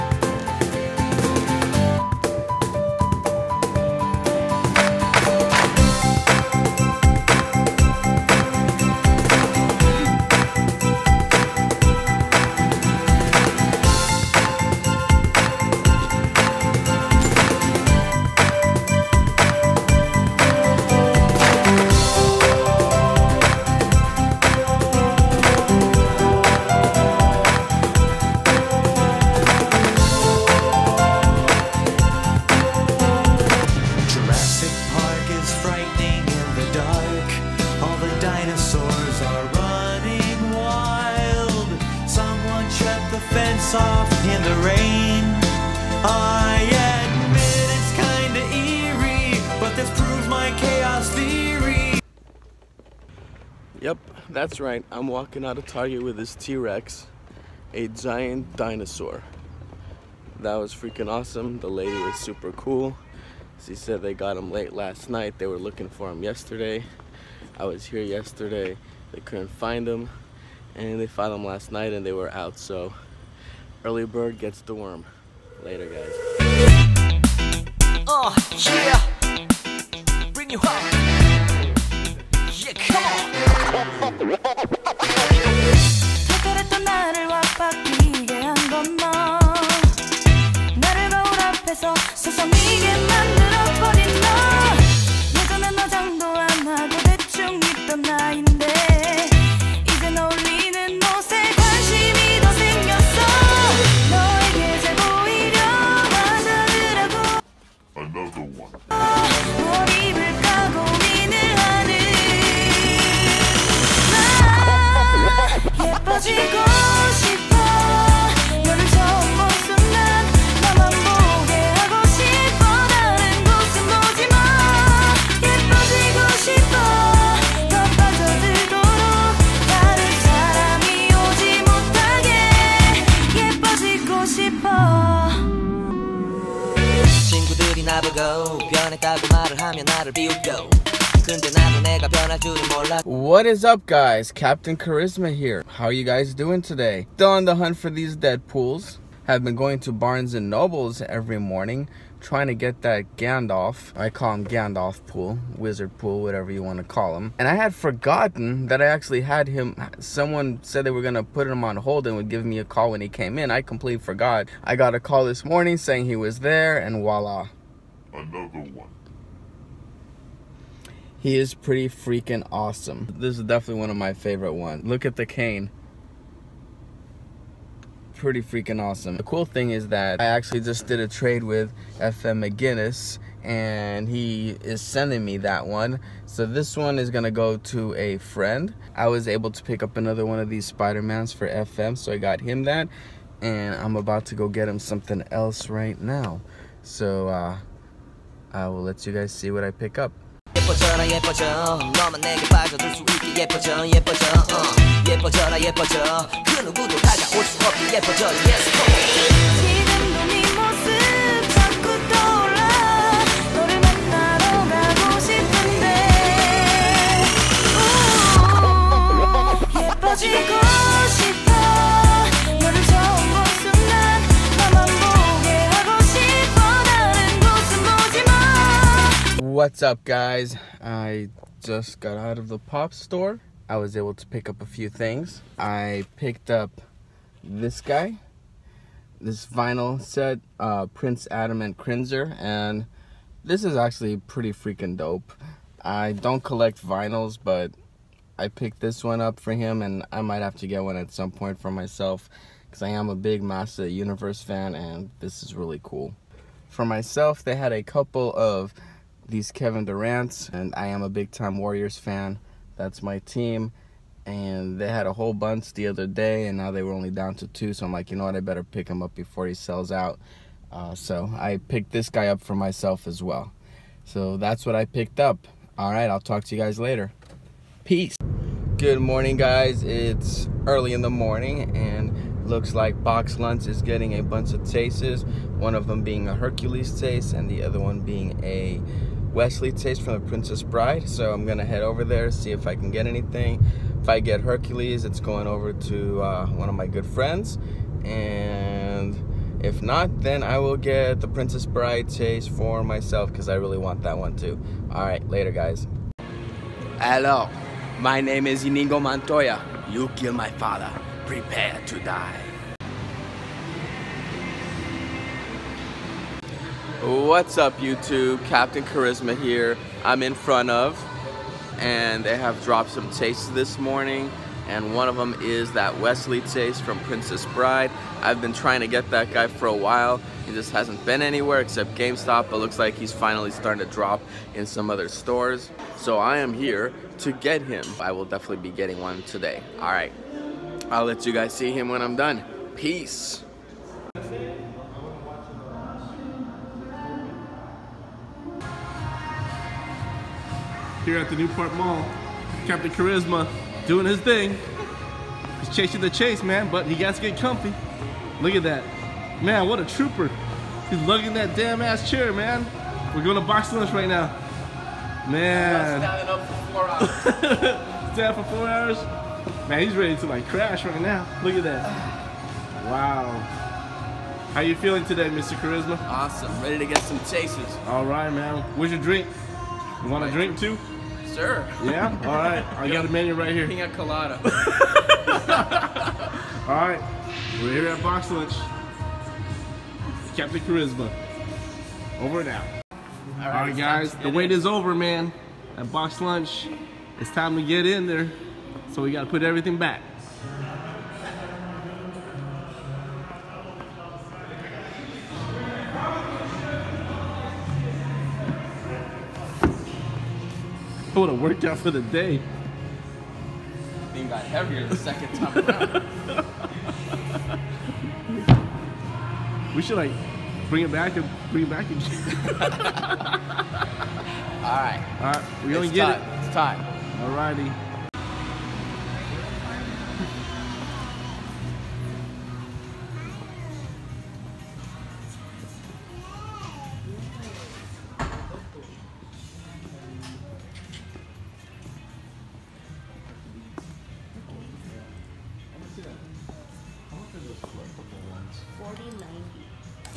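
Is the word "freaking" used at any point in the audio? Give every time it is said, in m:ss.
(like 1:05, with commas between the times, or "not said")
1:00, 2:51, 2:58, 4:04.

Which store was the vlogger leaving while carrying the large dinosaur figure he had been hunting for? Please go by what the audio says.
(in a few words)
Target.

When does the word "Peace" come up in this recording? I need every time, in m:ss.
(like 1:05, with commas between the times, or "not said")
4:37, 5:42.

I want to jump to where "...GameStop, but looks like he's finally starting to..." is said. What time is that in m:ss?
5:31.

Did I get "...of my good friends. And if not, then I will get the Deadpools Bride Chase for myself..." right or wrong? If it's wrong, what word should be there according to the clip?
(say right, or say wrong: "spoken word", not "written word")
wrong: "Princess", not "Deadpools".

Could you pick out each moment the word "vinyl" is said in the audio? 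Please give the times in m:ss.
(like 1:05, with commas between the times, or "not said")
3:59, 4:06.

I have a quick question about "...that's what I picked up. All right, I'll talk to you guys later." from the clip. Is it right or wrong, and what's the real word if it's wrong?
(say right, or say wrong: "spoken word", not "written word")
right.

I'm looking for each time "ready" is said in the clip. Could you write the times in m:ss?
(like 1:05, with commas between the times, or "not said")
6:09, 6:16.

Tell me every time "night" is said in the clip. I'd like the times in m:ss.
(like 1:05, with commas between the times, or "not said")
1:05, 1:11.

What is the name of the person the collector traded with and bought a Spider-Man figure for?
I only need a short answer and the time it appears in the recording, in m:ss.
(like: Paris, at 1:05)
FM McGinnis, at 3:01.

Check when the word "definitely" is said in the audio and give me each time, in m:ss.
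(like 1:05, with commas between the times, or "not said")
2:53, 5:38.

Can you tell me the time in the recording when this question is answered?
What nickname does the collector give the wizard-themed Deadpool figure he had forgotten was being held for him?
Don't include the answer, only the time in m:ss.
2:34.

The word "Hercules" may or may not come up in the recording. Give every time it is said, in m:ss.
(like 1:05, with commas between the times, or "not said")
4:46, 4:54.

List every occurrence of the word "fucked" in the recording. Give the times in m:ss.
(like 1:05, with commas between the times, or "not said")
not said.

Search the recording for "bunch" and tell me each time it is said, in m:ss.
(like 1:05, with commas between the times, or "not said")
4:25, 4:44.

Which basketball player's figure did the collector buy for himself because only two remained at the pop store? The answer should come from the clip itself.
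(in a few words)
Kevin Durant.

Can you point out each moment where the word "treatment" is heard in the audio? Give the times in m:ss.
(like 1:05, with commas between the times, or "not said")
not said.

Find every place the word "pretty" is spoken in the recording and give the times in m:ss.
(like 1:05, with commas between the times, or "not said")
2:51, 2:58, 4:04.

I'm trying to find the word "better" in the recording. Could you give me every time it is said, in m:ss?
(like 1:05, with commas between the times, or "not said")
4:28.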